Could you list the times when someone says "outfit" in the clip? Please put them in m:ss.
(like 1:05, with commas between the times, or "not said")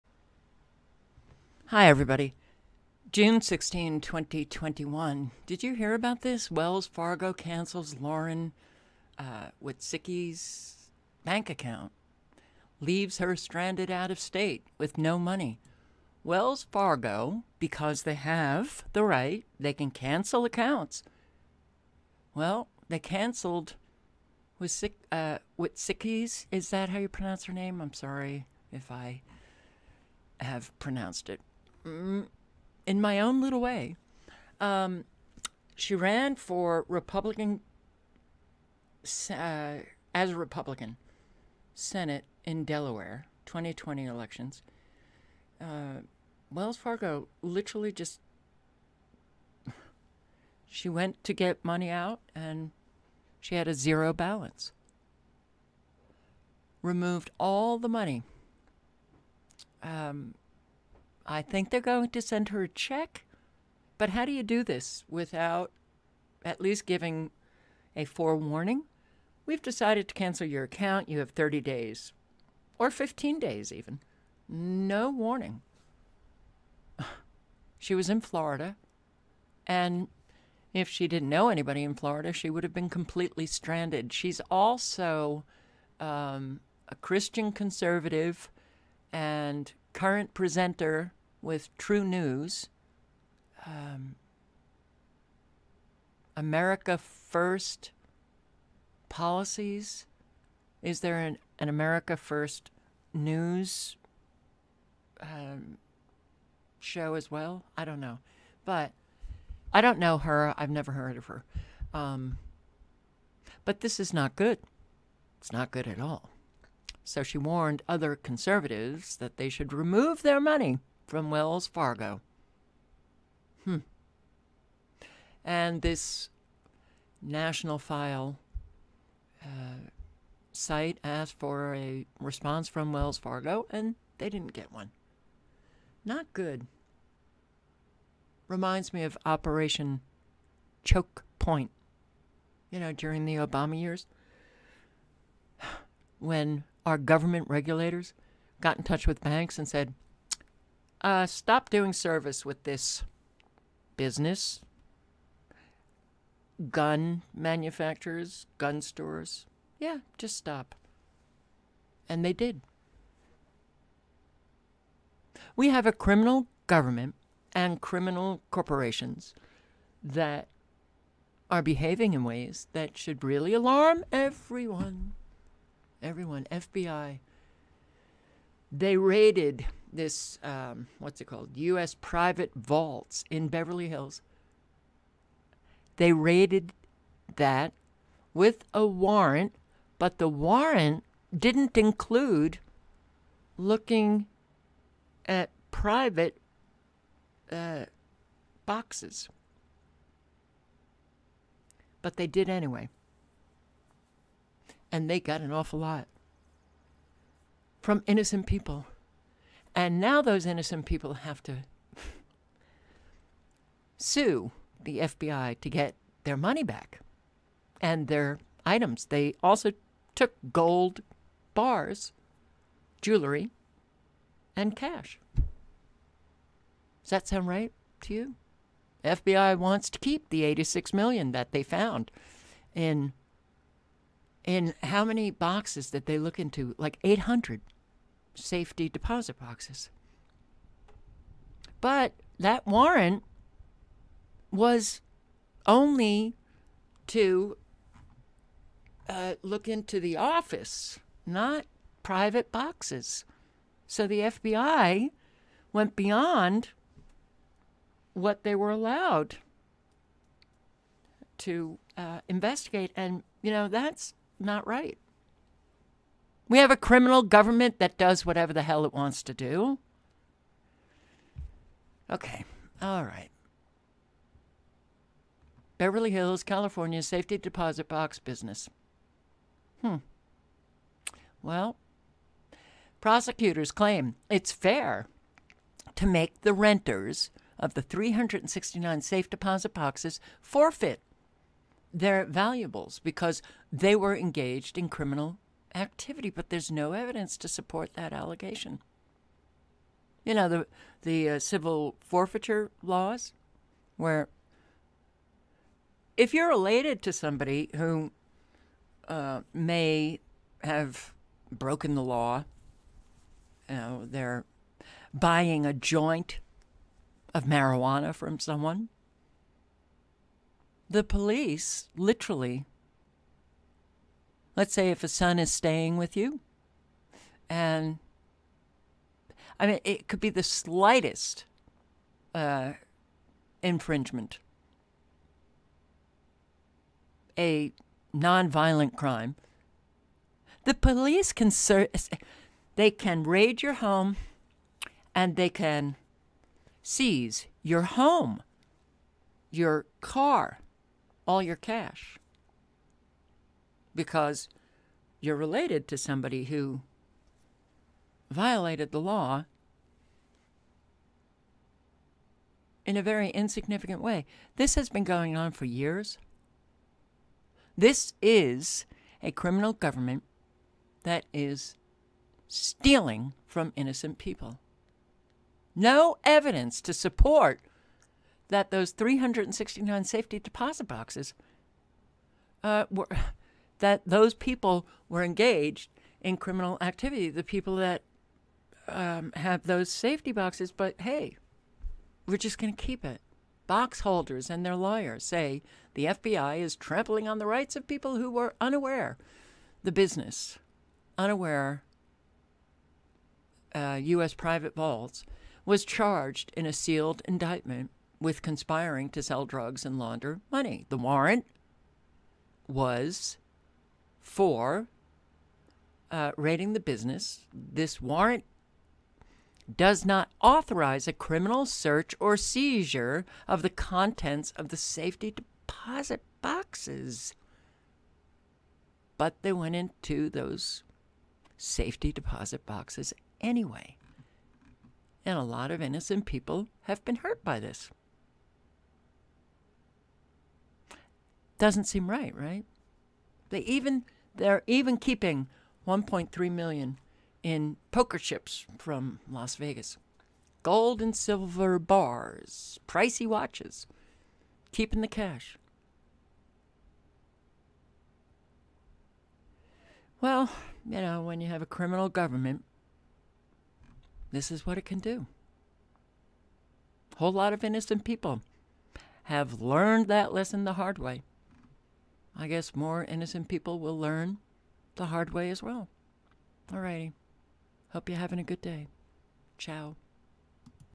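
not said.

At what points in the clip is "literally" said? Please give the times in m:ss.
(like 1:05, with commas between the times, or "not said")
0:47, 5:21.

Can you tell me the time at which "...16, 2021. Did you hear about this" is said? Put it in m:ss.
0:03.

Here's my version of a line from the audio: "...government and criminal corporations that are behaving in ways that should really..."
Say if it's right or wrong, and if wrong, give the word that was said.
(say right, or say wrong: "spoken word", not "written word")
right.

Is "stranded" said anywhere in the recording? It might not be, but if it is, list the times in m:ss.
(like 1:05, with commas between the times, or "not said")
0:13, 1:23.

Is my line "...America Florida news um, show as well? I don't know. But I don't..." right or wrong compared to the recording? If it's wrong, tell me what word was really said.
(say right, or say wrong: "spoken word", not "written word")
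wrong: "First", not "Florida".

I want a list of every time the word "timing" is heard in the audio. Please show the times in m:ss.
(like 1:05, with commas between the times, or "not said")
not said.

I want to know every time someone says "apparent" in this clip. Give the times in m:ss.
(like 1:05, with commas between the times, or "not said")
not said.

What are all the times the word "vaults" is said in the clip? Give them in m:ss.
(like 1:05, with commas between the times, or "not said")
3:02, 6:44.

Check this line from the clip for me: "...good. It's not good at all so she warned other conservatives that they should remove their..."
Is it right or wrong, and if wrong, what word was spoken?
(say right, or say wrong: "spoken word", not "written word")
right.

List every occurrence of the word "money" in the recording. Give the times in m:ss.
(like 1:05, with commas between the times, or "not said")
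0:15, 0:51, 0:57, 2:00, 3:36, 6:50.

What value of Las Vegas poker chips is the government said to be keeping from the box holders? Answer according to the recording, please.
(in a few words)
$1.3 million.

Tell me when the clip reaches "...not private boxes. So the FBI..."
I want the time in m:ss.
4:11.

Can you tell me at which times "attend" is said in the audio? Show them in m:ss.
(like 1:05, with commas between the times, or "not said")
not said.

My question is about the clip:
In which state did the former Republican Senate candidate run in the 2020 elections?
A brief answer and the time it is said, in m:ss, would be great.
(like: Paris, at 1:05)
Delaware, at 0:42.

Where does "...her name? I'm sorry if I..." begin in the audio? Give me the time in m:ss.
0:27.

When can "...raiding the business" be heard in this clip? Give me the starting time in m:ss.
6:56.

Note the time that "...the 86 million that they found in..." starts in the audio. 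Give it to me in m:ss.
3:50.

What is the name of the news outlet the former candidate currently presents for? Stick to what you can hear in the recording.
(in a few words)
True News.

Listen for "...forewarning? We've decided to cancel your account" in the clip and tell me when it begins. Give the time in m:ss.
1:08.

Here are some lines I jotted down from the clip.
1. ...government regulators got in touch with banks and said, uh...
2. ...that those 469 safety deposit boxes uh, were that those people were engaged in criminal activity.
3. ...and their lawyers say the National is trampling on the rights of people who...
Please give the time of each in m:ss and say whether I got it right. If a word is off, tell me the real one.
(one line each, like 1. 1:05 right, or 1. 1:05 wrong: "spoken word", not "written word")
1. 2:26 right
2. 6:18 wrong: "369", not "469"
3. 6:34 wrong: "FBI", not "National".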